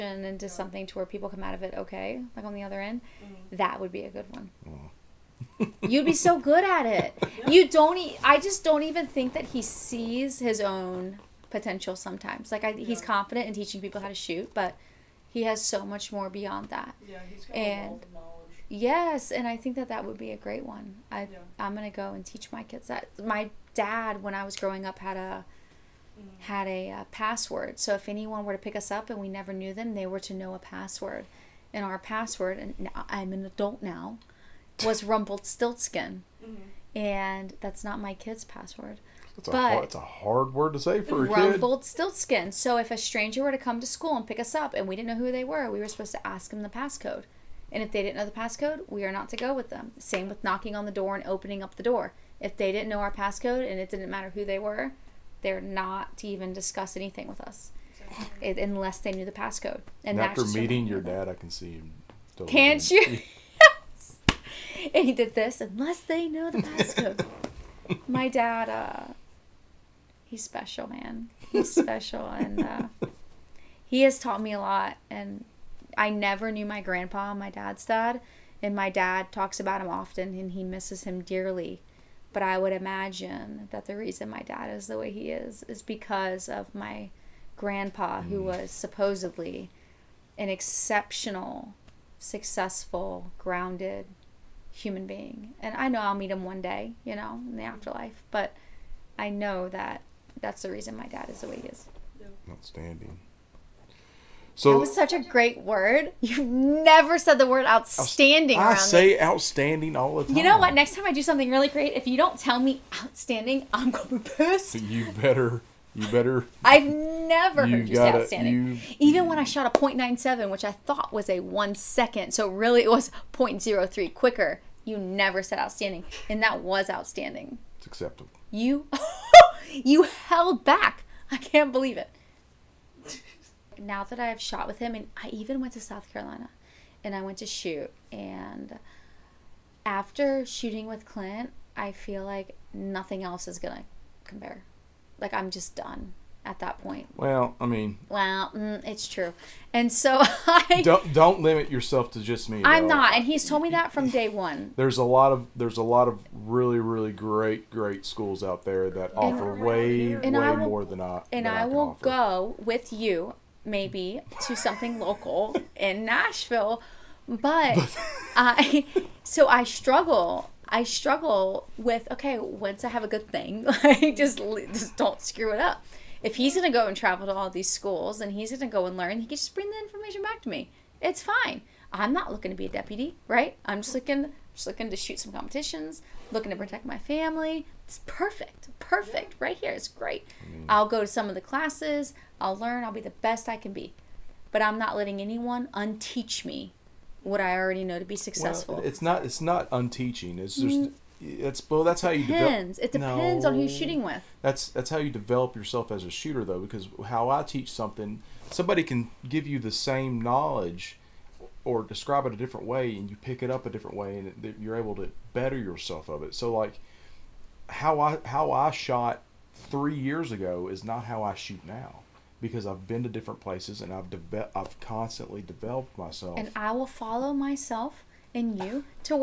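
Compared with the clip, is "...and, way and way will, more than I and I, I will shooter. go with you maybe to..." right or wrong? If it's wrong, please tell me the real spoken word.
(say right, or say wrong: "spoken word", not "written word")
wrong: "offer", not "shooter".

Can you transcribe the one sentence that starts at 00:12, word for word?
he's confident in teaching people how to shoot, but he has so much more beyond that.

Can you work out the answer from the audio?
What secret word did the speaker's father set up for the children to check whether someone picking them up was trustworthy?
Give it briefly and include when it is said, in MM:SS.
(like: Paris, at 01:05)
rumpled, at 00:35.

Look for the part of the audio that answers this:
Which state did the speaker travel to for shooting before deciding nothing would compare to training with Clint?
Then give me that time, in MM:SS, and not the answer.
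02:15.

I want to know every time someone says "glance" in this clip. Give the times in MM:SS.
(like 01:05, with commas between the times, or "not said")
not said.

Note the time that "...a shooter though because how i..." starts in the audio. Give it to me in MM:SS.
03:26.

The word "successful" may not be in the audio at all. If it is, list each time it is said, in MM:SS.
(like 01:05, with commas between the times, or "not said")
01:32, 03:18.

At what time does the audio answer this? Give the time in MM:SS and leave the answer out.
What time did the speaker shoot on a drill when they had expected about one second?
01:59.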